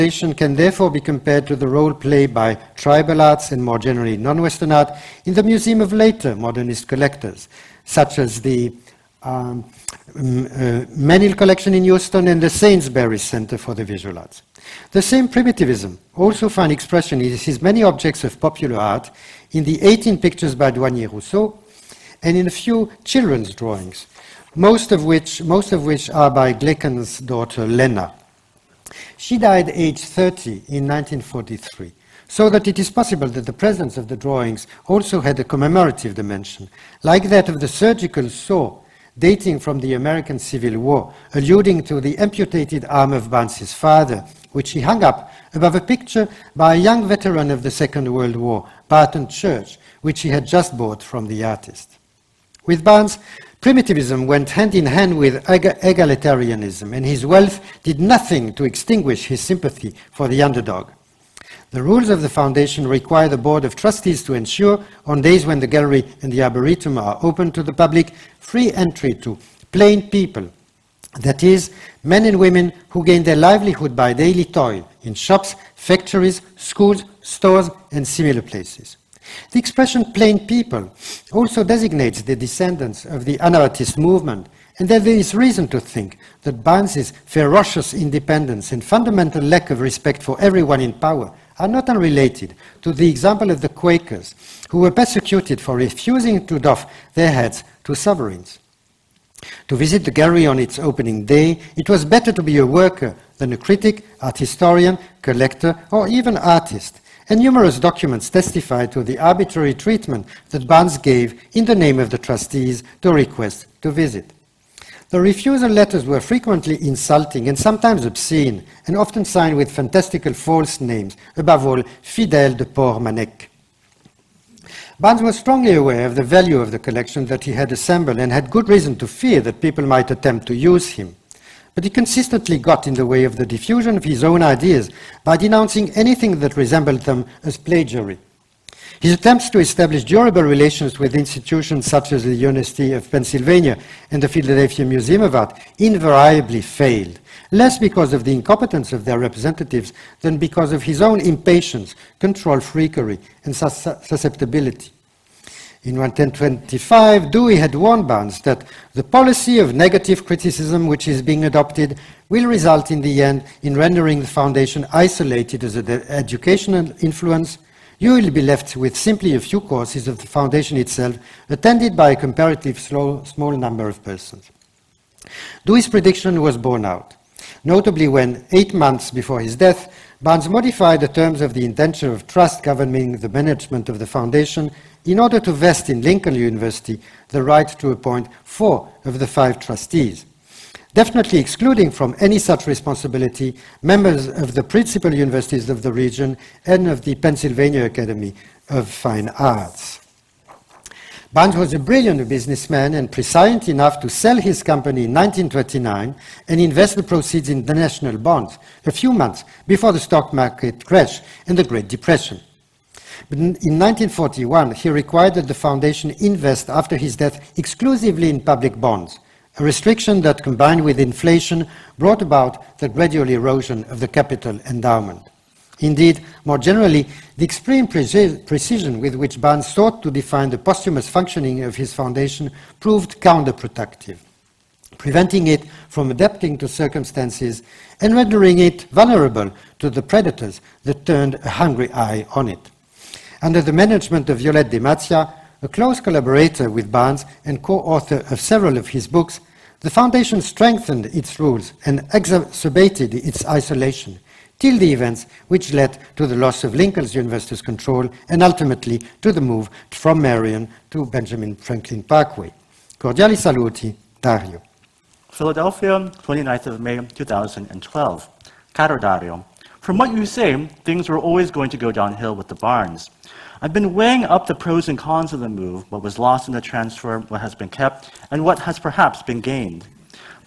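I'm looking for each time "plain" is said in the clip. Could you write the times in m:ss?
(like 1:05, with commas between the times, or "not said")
1:09, 1:20.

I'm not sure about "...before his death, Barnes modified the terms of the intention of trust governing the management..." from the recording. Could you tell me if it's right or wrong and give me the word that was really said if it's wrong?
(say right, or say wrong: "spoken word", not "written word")
right.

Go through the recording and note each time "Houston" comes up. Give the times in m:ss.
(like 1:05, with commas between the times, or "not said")
0:11.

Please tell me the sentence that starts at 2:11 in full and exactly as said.
But he consistently got in the way of the diffusion of his own ideas by denouncing anything that resembled them as plagiarism.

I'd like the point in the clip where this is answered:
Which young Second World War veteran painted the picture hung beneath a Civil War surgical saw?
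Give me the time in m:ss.
0:48.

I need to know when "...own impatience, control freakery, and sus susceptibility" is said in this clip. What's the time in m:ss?
2:30.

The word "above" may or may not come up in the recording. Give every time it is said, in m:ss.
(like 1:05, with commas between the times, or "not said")
0:45, 2:01.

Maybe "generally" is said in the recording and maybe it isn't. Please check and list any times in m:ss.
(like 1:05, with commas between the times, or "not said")
0:03, 3:46.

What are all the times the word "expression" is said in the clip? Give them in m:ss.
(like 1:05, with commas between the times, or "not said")
0:16, 1:19.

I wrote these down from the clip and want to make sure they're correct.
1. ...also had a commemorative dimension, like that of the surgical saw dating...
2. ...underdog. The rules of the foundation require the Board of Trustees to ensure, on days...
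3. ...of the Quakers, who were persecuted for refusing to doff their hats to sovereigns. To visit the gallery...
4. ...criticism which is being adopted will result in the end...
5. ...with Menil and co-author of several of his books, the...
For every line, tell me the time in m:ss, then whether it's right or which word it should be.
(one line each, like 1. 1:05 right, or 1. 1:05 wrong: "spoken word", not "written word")
1. 0:34 right
2. 1:00 right
3. 1:33 right
4. 2:40 right
5. 4:06 wrong: "Barnes", not "Menil".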